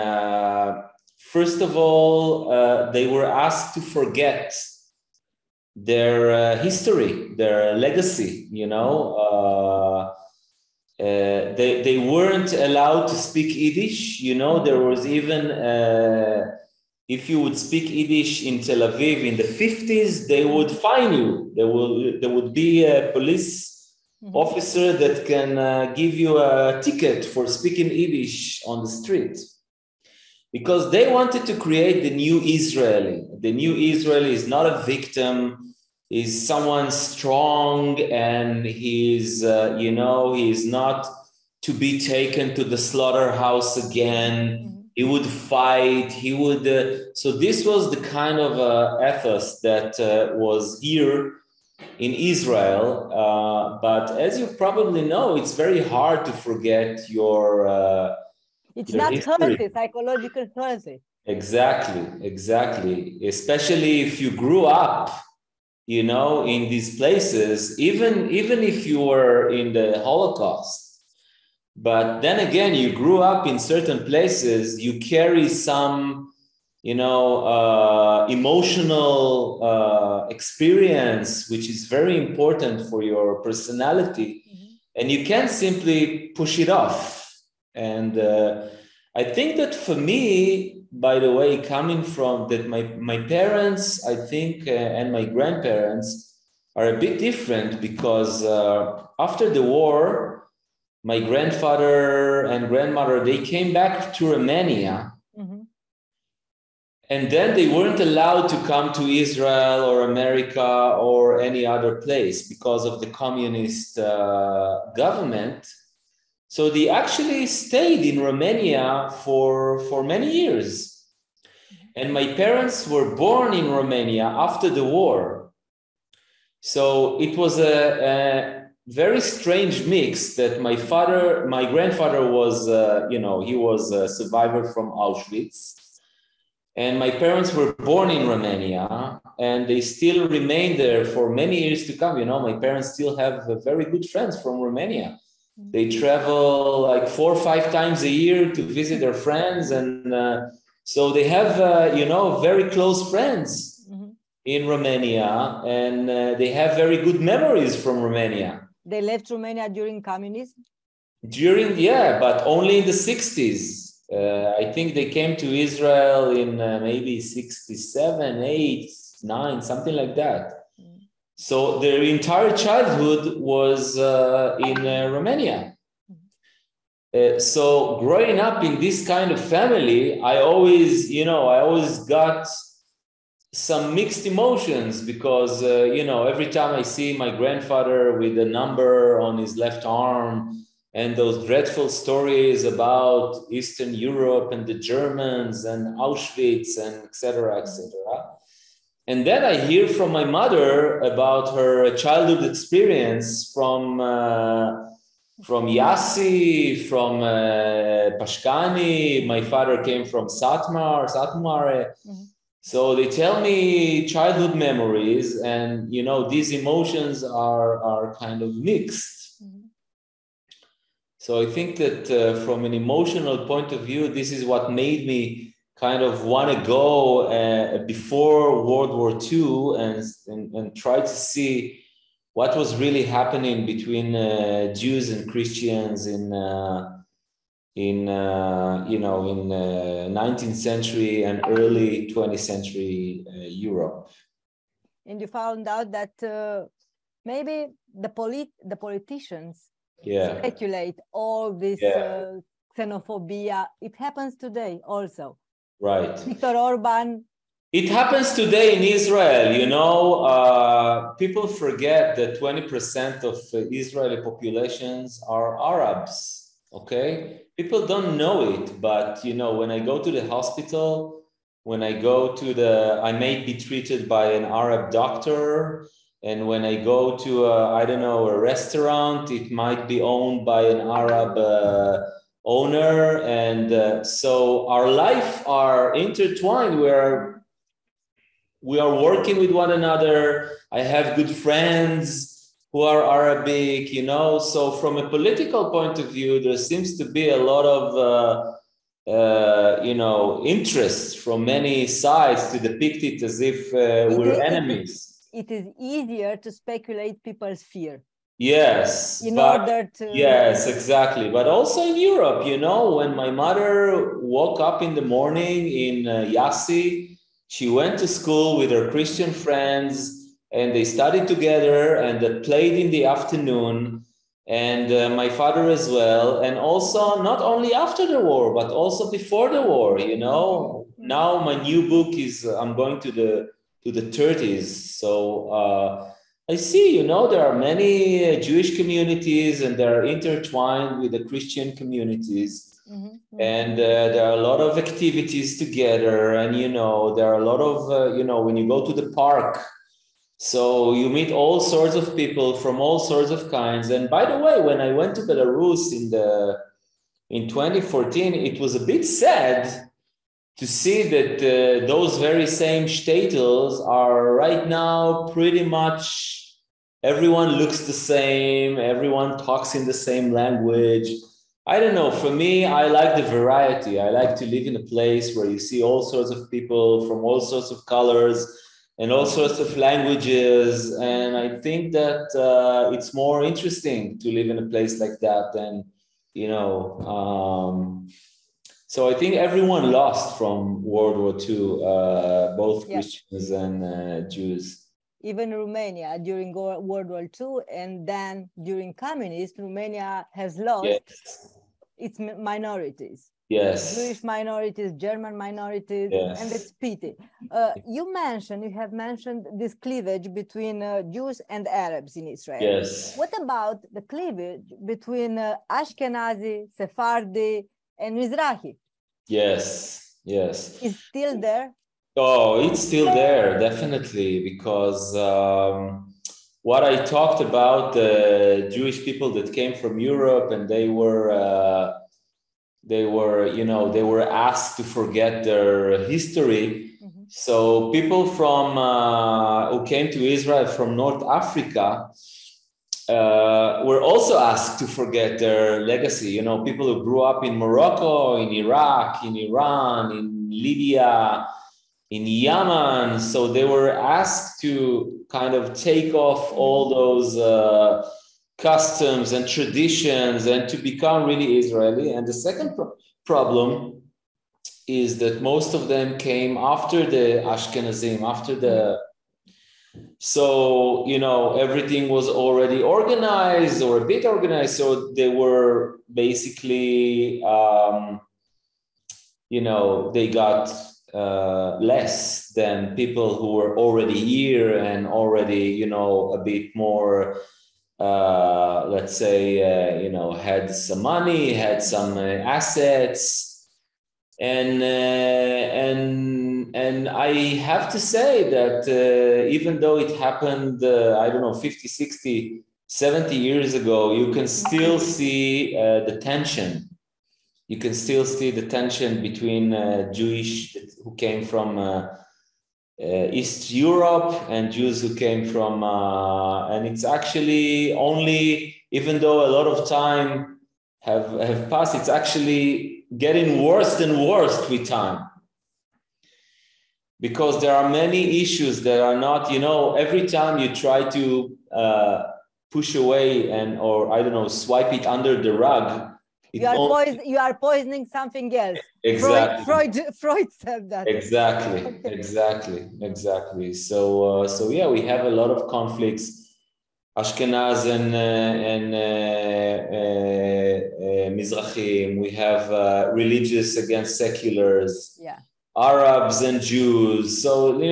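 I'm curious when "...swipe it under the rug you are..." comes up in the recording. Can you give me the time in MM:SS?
08:54.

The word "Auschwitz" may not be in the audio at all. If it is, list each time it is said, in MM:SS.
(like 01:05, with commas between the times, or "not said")
02:14, 03:15.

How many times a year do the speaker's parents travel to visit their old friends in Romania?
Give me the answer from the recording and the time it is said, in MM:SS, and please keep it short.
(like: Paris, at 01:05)
4 or 5, at 02:27.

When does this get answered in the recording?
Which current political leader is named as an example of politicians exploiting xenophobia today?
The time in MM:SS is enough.
04:16.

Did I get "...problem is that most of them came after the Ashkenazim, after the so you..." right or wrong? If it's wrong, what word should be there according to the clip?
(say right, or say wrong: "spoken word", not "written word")
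right.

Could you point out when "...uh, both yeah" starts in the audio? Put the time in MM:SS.
06:31.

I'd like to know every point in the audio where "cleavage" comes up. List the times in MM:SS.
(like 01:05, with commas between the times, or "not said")
06:49, 06:53.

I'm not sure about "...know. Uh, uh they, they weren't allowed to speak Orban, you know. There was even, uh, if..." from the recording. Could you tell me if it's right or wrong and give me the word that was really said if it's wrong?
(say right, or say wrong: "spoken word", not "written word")
wrong: "Yiddish", not "Orban".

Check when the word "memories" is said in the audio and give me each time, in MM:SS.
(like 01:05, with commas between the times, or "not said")
02:37, 03:34.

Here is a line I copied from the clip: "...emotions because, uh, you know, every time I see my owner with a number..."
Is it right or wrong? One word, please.
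wrong.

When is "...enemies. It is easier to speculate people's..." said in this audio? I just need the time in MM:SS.
05:04.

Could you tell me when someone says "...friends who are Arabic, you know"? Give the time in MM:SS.
04:51.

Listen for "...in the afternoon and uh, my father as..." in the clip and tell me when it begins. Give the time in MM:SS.
05:22.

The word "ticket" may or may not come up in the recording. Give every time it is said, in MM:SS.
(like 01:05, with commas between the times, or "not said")
00:26.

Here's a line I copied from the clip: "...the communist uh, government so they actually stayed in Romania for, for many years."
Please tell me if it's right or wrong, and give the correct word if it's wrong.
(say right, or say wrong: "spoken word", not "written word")
right.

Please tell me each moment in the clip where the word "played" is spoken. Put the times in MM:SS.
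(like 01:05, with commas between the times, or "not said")
05:22.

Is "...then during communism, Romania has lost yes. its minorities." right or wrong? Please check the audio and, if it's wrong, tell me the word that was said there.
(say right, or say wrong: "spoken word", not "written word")
right.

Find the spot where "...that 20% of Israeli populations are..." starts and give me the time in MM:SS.
04:22.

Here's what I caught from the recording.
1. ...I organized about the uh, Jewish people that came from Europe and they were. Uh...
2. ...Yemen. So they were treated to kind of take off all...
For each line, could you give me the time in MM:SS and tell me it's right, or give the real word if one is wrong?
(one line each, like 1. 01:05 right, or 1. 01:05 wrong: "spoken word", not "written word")
1. 07:06 wrong: "talked", not "organized"
2. 07:32 wrong: "asked", not "treated".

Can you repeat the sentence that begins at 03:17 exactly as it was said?
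etc and then I hear from my mother about her childhood experience from uh, from Yassi, from uh, Pașcani.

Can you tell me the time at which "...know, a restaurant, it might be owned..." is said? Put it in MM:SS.
04:38.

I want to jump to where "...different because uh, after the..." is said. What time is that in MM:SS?
01:37.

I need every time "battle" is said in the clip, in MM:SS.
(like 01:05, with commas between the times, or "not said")
not said.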